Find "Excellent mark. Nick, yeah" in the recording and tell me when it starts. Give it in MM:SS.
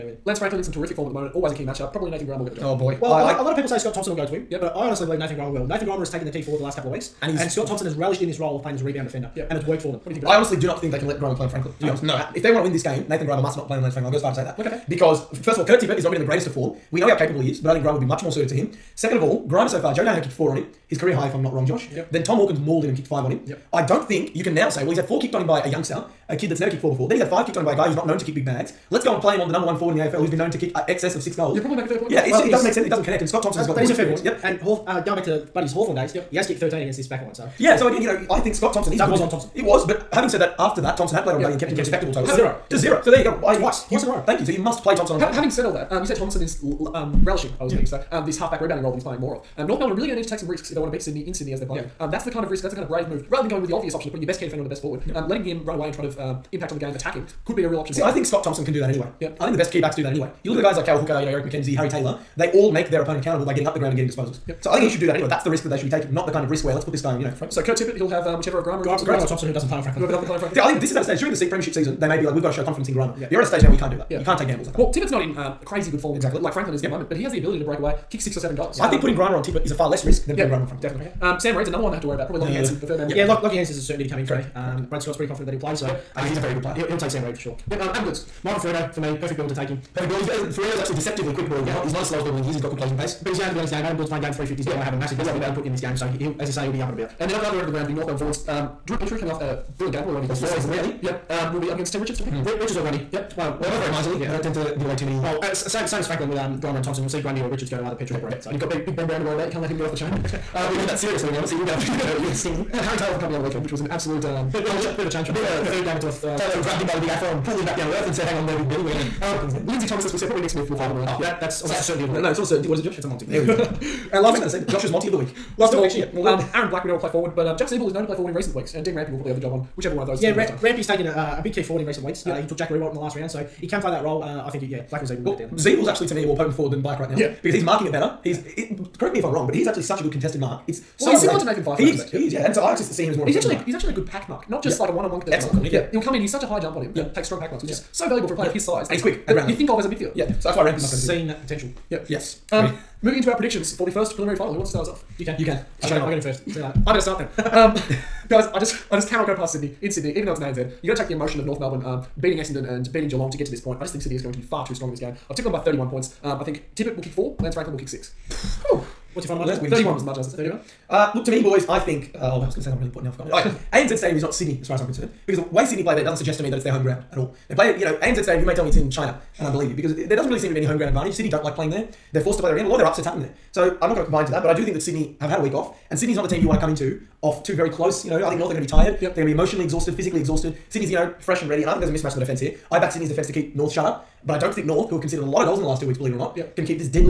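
02:25.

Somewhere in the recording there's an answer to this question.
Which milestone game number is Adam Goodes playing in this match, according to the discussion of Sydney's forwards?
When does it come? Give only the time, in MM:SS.
01:34.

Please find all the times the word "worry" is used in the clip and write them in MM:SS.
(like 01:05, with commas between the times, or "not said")
01:22, 01:49.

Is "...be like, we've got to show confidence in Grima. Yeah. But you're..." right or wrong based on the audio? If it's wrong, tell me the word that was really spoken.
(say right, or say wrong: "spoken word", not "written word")
right.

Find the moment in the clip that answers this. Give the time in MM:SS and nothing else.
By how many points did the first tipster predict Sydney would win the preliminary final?
02:45.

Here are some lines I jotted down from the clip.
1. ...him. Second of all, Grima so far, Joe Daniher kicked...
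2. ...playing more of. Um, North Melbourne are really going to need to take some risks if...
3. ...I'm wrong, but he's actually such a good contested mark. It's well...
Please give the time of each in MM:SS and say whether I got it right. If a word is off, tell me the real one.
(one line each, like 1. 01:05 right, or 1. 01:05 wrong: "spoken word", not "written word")
1. 00:18 right
2. 00:49 right
3. 02:19 right.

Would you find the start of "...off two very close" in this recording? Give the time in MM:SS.
03:07.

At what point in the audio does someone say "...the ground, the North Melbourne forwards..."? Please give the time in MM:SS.
01:37.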